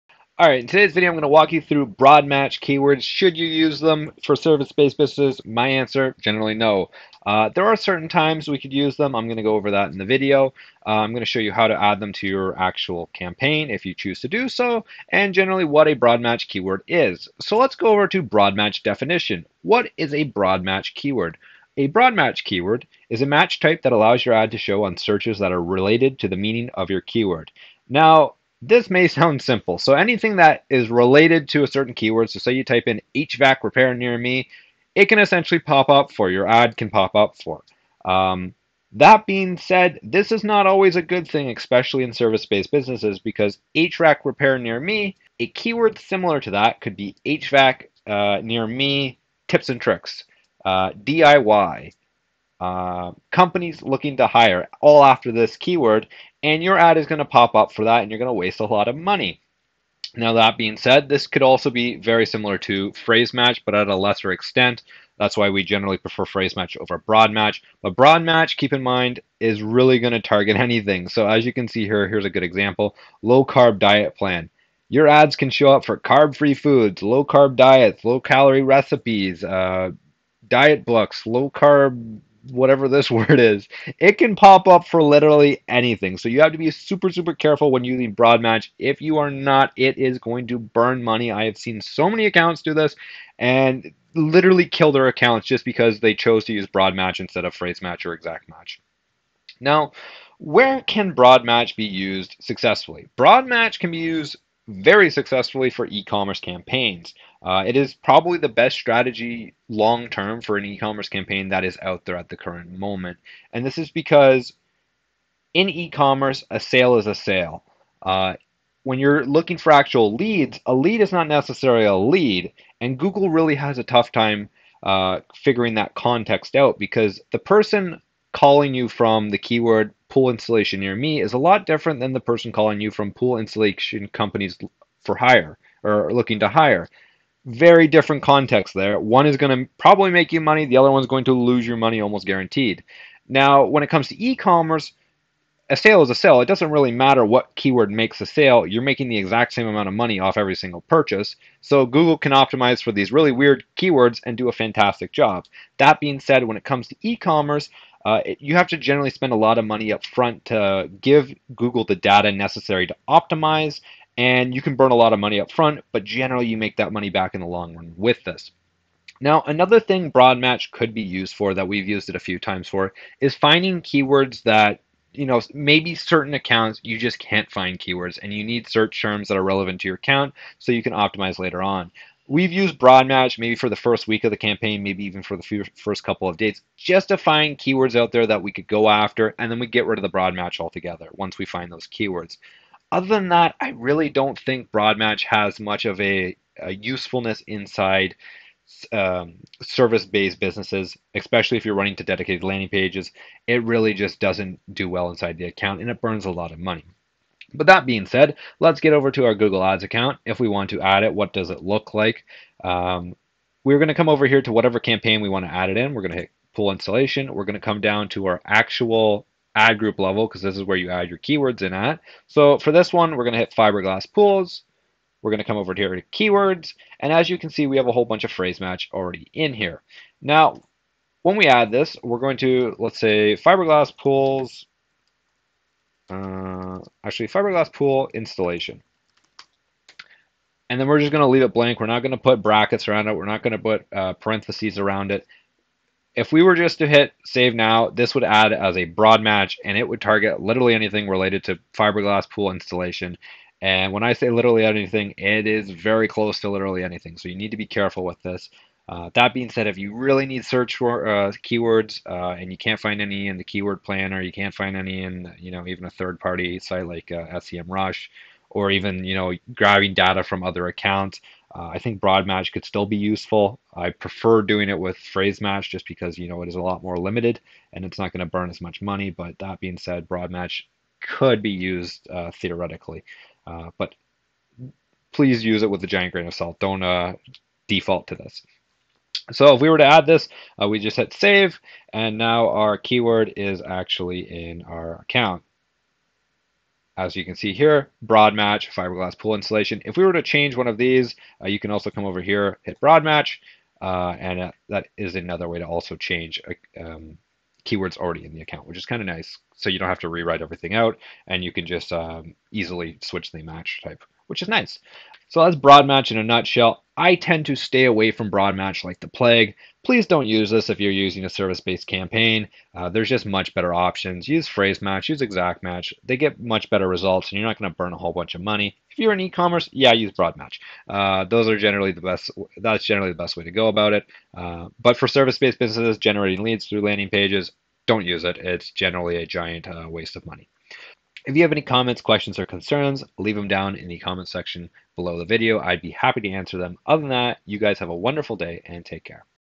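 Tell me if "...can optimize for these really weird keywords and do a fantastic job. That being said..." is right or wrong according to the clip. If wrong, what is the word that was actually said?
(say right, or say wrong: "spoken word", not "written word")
right.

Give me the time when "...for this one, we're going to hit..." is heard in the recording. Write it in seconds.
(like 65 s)
222 s.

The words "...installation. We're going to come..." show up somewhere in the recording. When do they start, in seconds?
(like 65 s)
216 s.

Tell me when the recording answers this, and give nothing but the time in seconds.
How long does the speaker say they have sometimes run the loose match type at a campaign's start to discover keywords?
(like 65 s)
183 s.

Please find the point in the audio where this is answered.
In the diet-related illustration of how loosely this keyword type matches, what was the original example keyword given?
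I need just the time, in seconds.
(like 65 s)
73 s.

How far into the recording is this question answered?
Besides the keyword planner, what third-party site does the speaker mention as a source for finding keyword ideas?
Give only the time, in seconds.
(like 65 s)
267 s.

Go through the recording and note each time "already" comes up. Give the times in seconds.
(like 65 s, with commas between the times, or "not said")
228 s, 307 s.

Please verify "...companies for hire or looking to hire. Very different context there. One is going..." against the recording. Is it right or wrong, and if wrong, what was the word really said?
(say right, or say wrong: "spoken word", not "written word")
right.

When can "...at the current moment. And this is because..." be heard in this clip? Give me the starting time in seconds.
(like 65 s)
112 s.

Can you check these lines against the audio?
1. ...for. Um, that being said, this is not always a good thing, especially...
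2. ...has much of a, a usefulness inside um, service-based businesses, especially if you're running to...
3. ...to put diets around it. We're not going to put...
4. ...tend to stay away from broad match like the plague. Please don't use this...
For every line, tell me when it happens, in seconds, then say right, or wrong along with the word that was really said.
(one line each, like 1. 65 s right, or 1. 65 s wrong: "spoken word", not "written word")
1. 37 s right
2. 195 s right
3. 242 s wrong: "brackets", not "diets"
4. 317 s right.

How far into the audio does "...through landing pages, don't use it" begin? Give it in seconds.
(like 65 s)
336 s.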